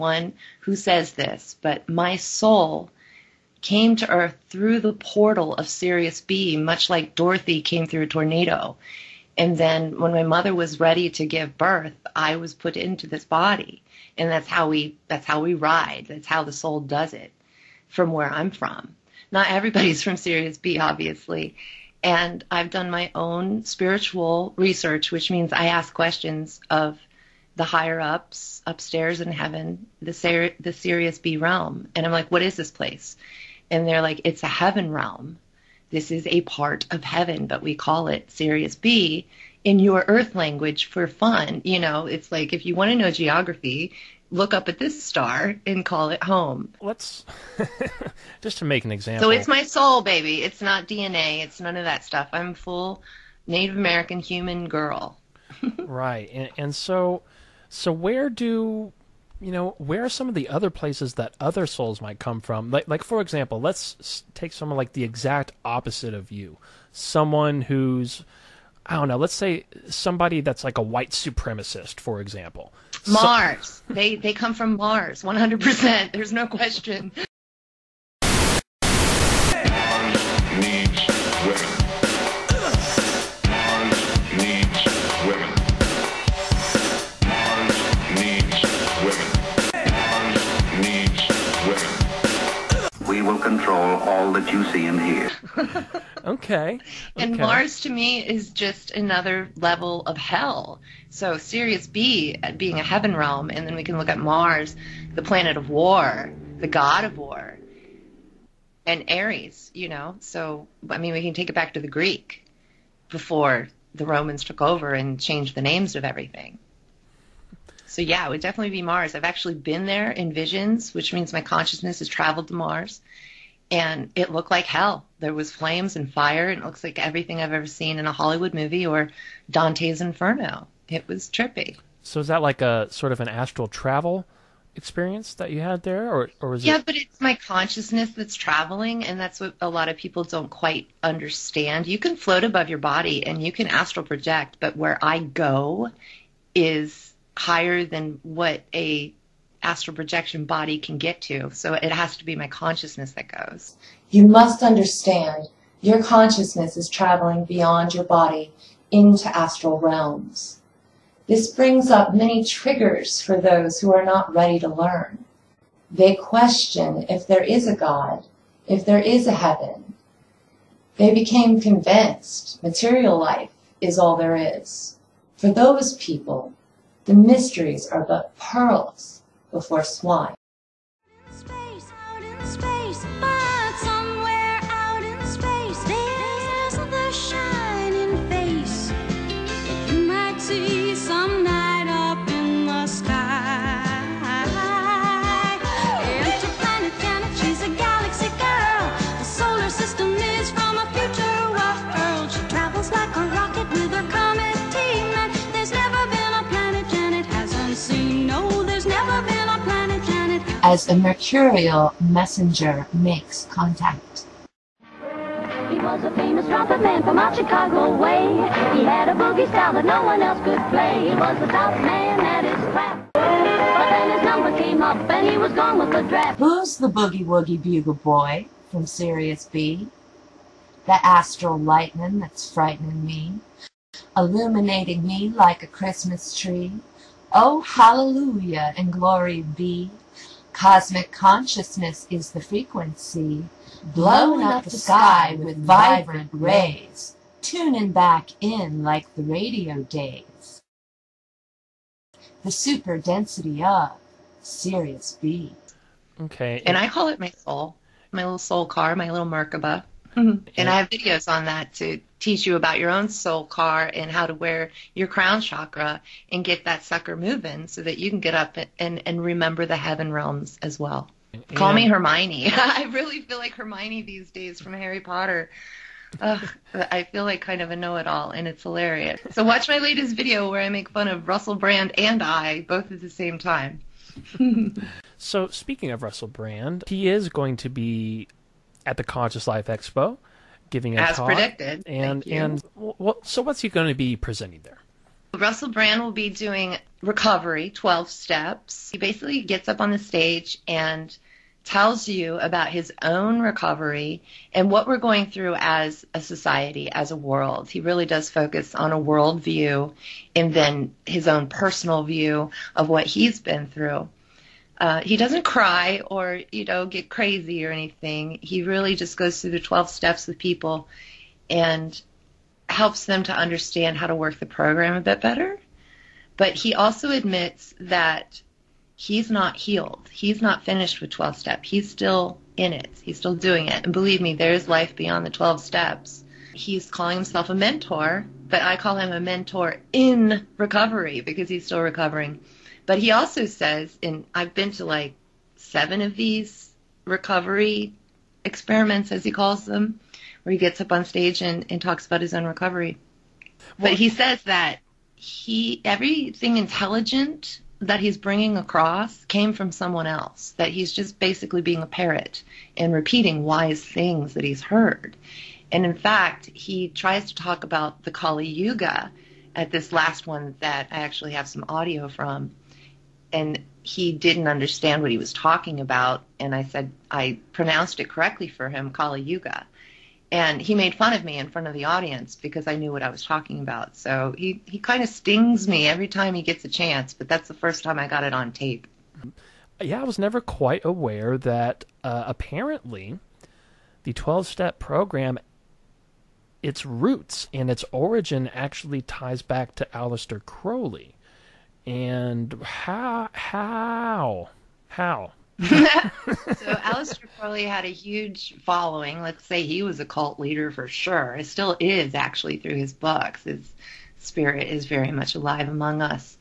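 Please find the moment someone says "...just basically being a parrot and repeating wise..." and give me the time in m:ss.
6:00.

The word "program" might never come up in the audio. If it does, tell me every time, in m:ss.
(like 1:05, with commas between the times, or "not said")
5:24, 6:34.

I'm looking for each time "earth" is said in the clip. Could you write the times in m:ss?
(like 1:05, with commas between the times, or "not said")
0:04, 0:40.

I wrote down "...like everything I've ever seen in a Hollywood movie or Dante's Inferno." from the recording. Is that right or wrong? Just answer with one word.
right.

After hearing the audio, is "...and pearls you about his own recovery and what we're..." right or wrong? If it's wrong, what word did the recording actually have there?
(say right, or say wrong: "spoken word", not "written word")
wrong: "tells", not "pearls".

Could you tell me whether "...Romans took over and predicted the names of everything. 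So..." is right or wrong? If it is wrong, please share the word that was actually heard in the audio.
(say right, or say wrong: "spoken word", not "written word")
wrong: "changed", not "predicted".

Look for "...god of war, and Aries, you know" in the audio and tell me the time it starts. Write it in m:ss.
1:46.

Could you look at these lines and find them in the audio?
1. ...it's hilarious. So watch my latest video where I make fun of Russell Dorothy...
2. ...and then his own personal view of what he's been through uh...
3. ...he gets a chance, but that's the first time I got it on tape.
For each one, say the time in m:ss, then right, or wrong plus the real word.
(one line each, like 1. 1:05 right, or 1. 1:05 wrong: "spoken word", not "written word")
1. 4:38 wrong: "Brand", not "Dorothy"
2. 5:10 right
3. 6:26 right.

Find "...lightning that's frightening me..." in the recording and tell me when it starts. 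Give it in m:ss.
3:51.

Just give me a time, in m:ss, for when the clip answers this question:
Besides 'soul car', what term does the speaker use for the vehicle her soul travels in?
4:19.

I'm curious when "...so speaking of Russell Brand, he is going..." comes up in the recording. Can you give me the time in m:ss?
4:45.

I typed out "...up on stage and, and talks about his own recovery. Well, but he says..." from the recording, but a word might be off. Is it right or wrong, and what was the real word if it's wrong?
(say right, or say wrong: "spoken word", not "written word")
right.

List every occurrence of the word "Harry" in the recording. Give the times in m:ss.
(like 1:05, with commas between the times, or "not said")
4:34.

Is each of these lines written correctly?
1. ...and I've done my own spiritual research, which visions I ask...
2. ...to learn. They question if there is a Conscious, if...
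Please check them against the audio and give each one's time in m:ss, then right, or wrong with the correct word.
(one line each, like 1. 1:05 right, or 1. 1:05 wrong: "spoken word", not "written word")
1. 0:22 wrong: "means", not "visions"
2. 2:44 wrong: "God", not "Conscious".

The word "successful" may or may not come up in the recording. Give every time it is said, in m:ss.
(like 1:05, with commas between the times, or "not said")
not said.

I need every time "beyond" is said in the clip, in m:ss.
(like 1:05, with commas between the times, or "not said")
2:37, 5:34.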